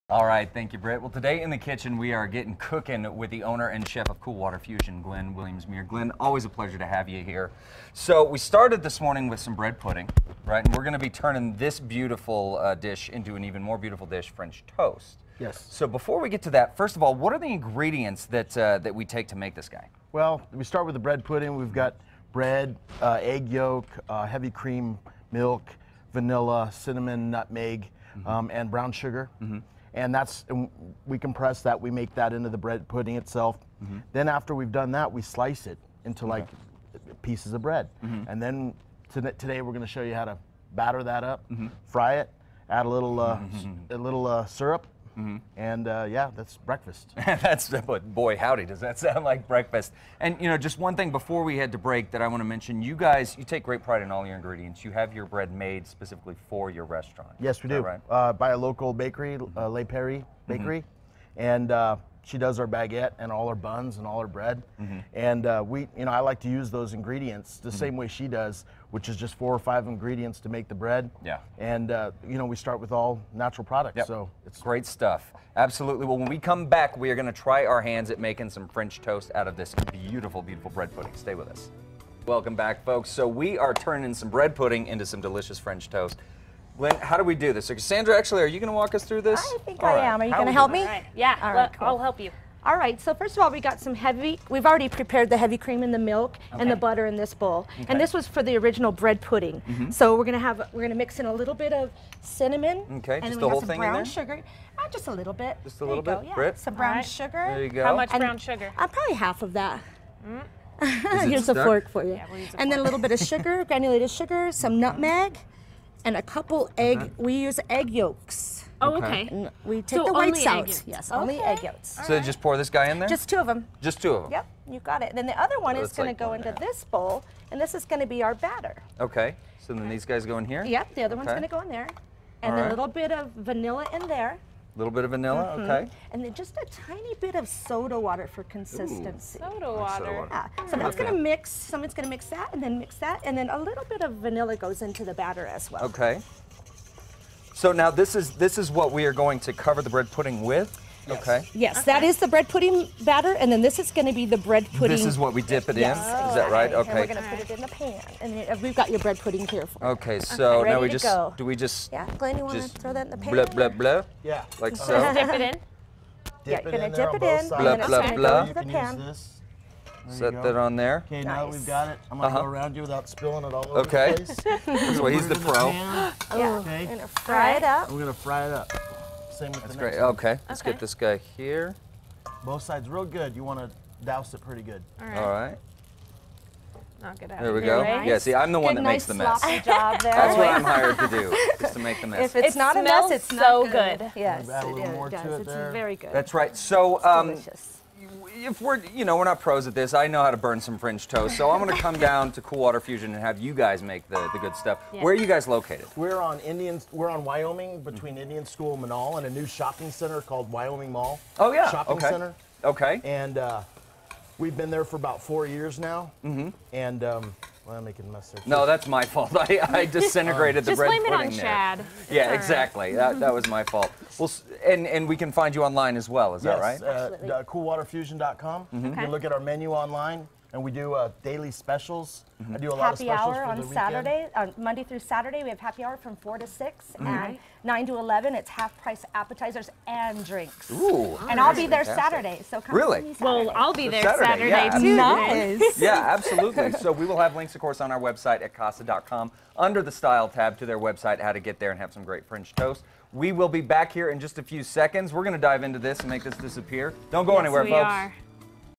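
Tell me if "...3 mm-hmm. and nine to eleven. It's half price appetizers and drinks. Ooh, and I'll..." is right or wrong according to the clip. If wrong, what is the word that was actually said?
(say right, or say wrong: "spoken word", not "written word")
wrong: "6", not "3".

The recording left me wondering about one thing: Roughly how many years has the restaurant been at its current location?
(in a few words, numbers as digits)
4 years.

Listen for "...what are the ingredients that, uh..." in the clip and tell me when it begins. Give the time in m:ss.
0:17.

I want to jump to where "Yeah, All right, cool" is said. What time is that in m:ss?
1:31.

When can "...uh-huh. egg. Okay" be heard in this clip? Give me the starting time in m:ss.
1:56.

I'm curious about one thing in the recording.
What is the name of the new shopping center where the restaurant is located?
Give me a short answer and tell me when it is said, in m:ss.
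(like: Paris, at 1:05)
Wyoming Mall, at 3:30.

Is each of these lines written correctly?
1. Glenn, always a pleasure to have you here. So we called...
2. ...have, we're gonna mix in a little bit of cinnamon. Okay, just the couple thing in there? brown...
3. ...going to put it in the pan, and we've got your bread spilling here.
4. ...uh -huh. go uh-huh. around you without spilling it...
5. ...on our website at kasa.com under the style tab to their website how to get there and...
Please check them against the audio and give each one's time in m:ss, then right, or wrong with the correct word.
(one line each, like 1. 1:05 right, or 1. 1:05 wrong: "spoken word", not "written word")
1. 0:05 wrong: "started", not "called"
2. 1:40 wrong: "whole", not "couple"
3. 2:37 wrong: "pudding", not "spilling"
4. 2:52 right
5. 4:07 right.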